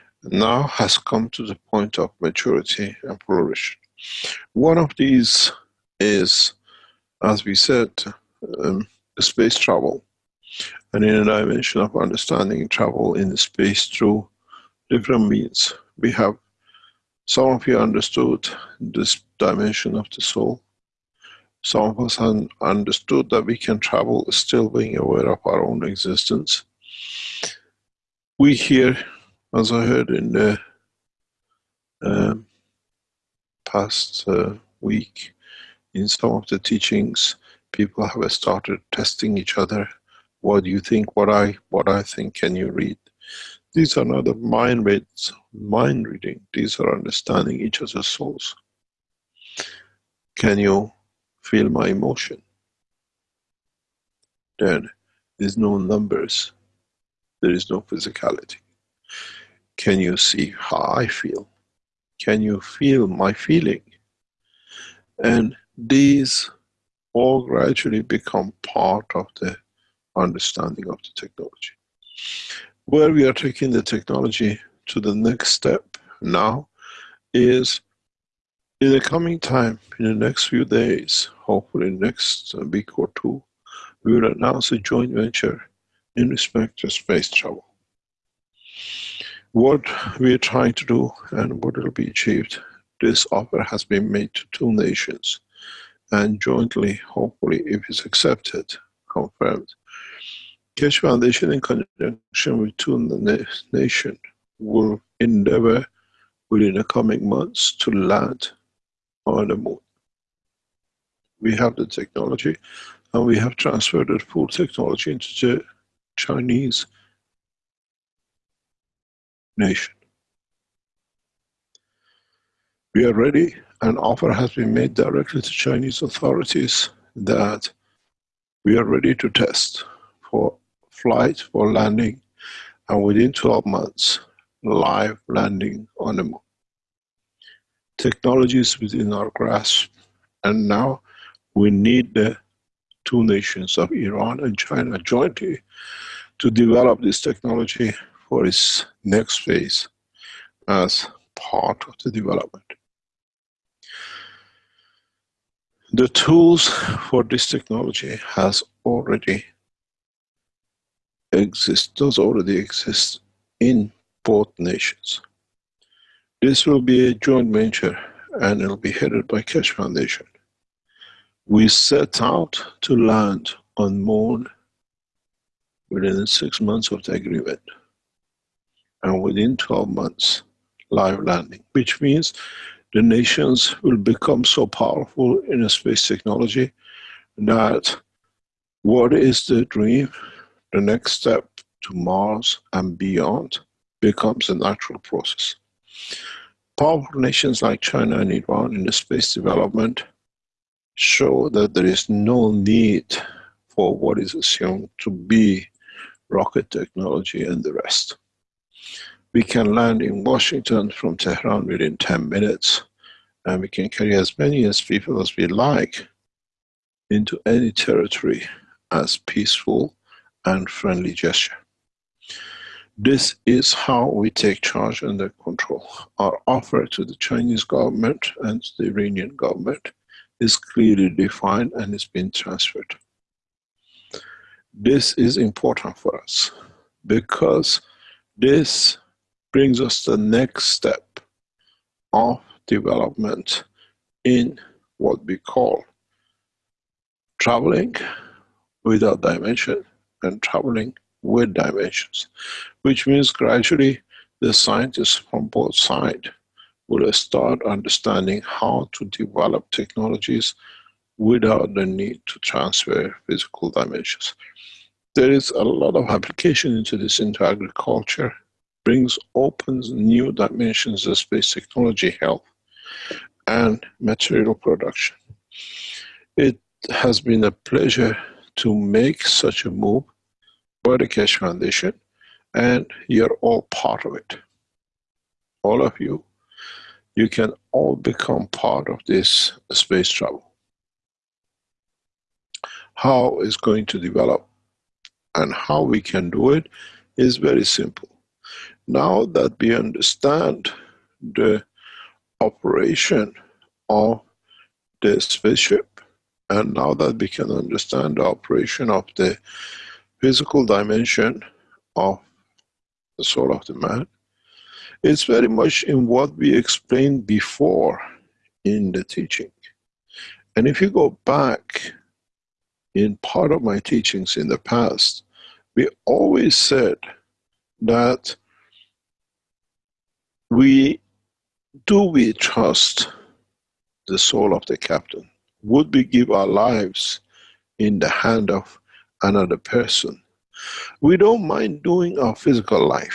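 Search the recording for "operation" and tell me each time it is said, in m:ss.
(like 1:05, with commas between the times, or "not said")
5:02, 5:08.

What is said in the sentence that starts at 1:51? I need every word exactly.
We have the technology and we have transferred the full technology into the Chinese nation.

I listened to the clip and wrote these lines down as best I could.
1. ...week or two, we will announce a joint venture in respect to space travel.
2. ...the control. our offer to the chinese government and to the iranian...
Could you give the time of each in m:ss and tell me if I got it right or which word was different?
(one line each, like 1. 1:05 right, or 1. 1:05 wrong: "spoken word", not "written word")
1. 1:22 right
2. 3:45 right.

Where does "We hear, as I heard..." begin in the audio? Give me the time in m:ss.
0:28.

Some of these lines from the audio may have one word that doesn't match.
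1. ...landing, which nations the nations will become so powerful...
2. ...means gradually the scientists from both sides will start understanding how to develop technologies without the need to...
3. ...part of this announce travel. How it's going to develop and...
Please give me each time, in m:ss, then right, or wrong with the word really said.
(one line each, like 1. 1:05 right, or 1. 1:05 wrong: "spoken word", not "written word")
1. 3:01 wrong: "means", not "nations"
2. 4:13 right
3. 4:48 wrong: "space", not "announce".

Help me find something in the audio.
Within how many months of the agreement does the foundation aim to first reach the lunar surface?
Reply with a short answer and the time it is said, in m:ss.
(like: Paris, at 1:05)
6, at 2:56.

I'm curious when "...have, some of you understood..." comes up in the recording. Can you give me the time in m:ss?
0:16.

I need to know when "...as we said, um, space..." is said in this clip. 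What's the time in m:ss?
0:07.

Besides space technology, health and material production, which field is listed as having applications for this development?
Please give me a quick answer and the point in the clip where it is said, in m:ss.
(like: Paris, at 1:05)
Agriculture, at 4:27.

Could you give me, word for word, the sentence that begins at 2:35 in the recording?
The tools for this technology has already exist, does already exist in both nations.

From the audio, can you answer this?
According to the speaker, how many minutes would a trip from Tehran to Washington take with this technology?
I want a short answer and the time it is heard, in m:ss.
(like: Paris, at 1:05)
10, at 3:31.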